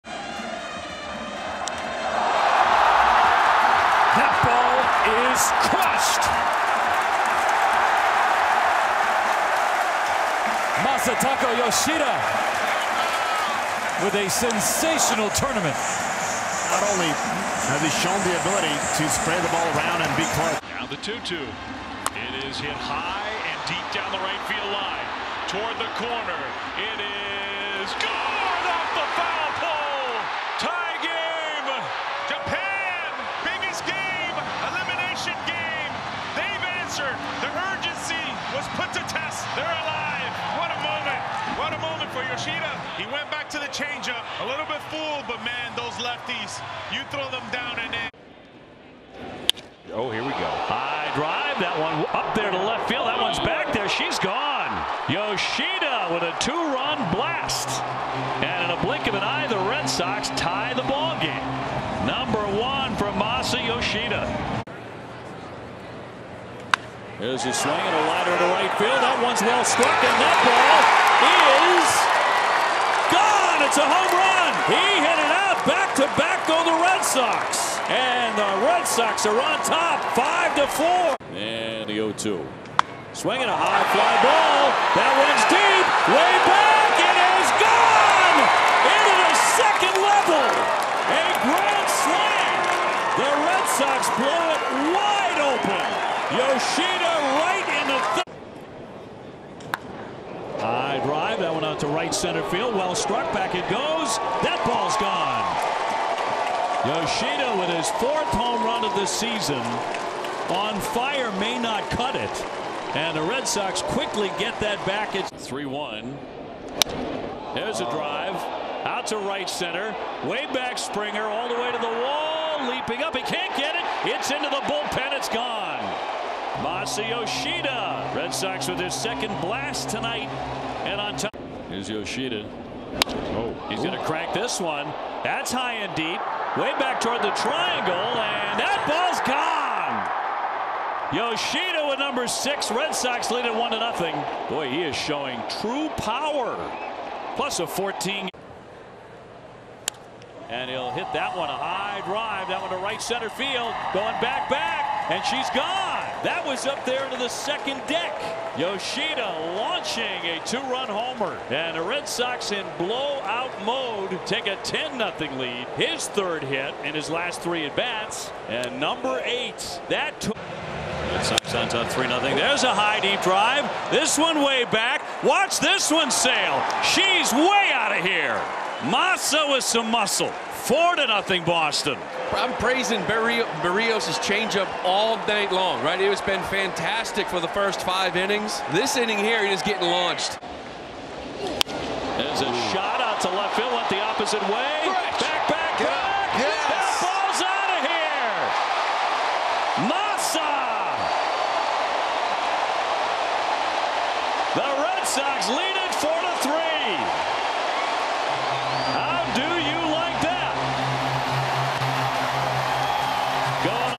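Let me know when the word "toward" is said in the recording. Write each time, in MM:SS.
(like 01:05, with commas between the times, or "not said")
00:25, 02:16.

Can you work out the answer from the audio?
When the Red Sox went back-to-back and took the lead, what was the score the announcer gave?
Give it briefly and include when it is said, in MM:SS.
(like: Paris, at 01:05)
5-4, at 01:20.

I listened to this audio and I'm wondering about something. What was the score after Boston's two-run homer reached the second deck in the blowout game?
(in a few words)
10-0.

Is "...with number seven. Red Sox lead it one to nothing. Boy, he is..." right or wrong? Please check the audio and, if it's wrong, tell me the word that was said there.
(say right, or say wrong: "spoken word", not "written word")
wrong: "six", not "seven".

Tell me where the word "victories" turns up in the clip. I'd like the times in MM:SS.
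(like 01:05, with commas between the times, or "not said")
not said.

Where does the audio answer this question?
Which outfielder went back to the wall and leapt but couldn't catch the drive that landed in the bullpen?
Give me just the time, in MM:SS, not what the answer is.
02:00.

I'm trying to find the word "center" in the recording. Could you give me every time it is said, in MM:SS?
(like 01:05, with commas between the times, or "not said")
01:42, 01:59, 02:33.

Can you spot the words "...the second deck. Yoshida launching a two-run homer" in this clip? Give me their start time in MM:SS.
02:37.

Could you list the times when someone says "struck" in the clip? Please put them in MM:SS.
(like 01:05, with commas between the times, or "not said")
01:09, 01:42.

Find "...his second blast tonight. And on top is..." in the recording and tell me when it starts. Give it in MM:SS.
02:08.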